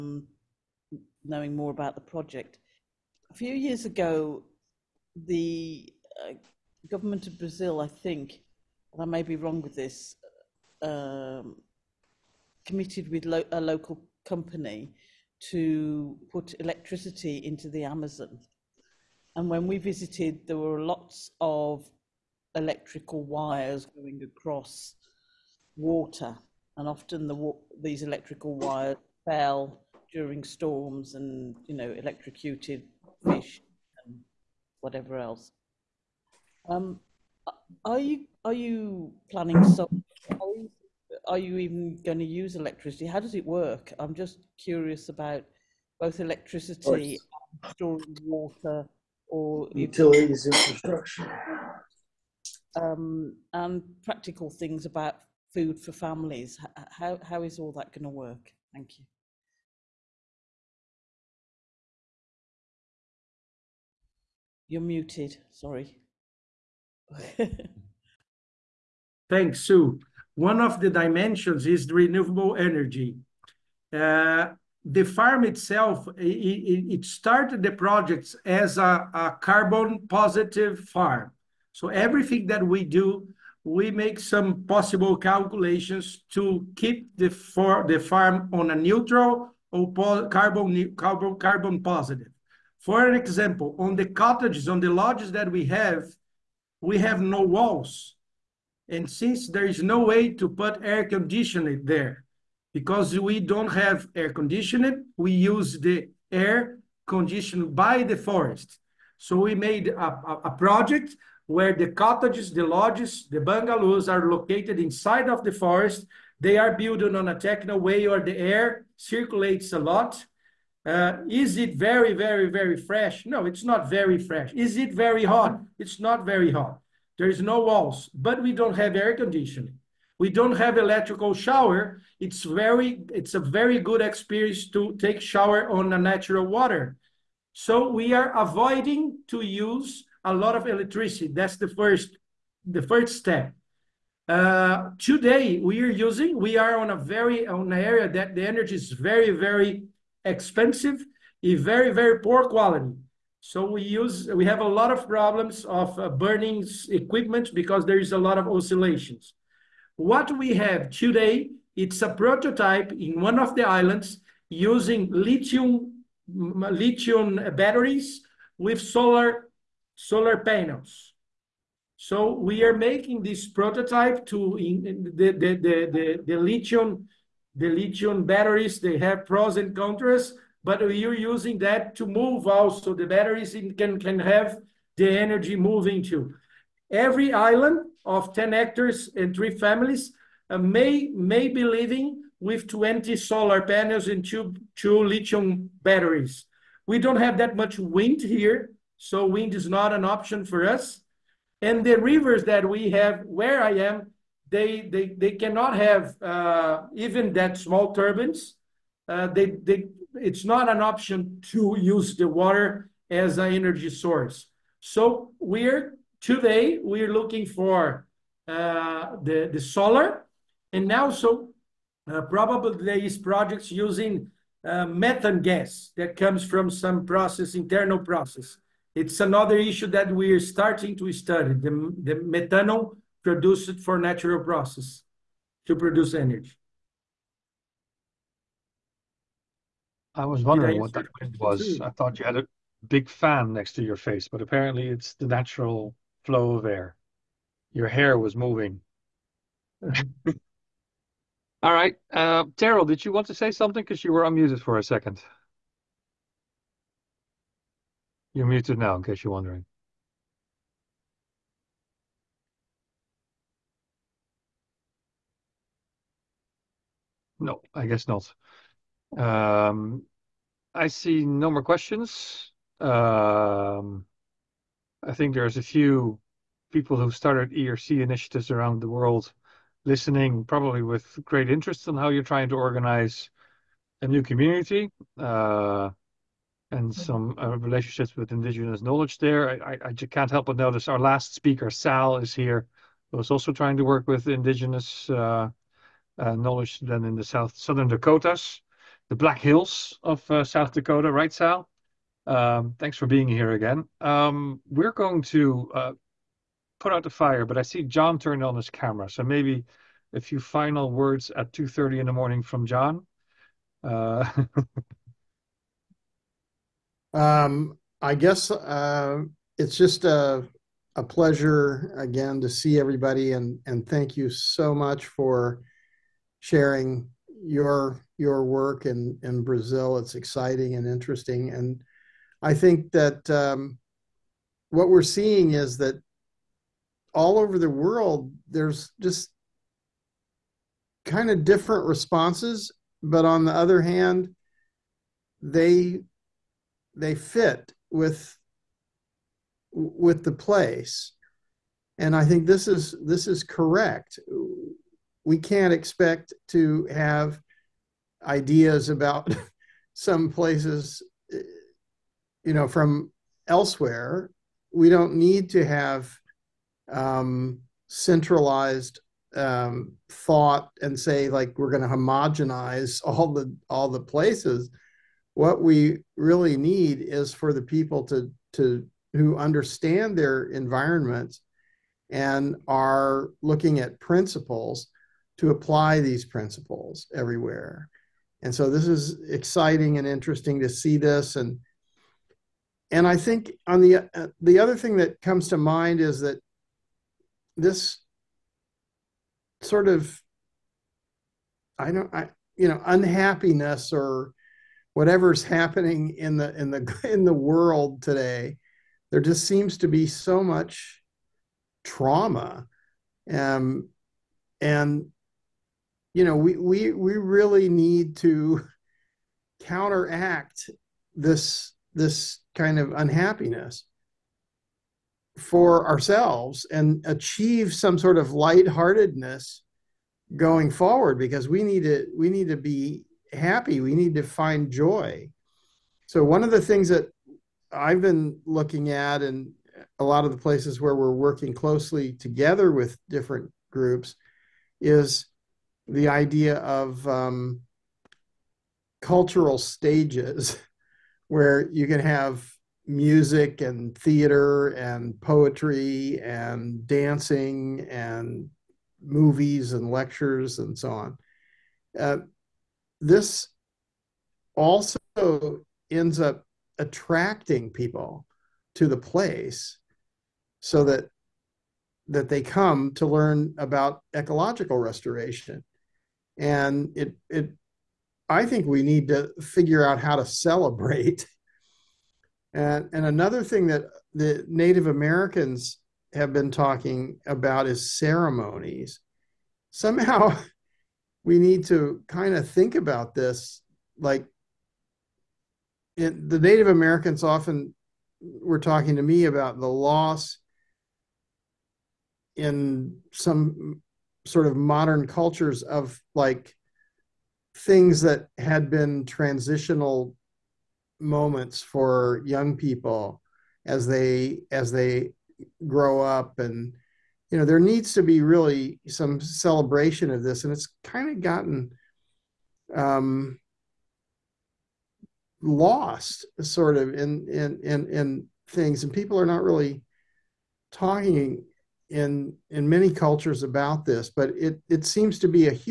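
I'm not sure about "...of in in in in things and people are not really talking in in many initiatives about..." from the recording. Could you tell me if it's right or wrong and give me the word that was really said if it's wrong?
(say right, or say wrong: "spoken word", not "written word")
wrong: "cultures", not "initiatives".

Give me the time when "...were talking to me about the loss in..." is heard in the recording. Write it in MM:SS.
08:18.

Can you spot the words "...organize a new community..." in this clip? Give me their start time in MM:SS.
04:42.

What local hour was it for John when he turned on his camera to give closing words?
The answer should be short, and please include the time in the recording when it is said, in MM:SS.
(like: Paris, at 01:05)
2:30 a.m., at 05:11.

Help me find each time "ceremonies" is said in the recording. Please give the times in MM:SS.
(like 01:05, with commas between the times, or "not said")
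08:07.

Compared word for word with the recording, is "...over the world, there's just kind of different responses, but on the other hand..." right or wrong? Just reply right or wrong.
right.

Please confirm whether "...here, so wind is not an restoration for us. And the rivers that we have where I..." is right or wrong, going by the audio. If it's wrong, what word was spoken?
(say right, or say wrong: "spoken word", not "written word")
wrong: "option", not "restoration".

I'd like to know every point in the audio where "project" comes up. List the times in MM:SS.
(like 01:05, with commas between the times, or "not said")
00:02, 01:17, 01:50, 03:43.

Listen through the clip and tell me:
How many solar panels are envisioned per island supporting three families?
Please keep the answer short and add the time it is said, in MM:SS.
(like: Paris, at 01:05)
20, at 03:12.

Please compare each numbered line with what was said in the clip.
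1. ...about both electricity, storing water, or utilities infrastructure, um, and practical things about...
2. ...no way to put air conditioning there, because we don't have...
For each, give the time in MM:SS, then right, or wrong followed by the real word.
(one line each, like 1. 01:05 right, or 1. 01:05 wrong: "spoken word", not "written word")
1. 00:45 right
2. 01:39 right.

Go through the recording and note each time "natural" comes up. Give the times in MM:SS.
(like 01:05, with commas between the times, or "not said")
02:15, 03:53, 04:05.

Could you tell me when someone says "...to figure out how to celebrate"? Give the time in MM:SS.
07:59.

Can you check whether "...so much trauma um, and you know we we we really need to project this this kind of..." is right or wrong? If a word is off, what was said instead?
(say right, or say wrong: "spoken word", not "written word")
wrong: "counteract", not "project".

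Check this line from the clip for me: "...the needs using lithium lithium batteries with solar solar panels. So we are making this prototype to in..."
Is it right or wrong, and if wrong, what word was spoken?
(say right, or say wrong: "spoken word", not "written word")
wrong: "islands", not "needs".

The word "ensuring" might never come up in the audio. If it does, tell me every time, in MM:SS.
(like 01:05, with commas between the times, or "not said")
not said.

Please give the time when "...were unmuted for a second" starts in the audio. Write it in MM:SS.
04:14.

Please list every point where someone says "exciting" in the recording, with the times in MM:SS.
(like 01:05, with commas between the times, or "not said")
05:30, 06:29.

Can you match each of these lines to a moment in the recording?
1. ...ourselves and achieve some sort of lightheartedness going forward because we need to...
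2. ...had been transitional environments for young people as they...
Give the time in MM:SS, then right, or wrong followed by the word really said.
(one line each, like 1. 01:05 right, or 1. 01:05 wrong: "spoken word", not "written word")
1. 07:05 right
2. 08:28 wrong: "moments", not "environments".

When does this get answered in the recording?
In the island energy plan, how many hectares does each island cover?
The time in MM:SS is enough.
03:08.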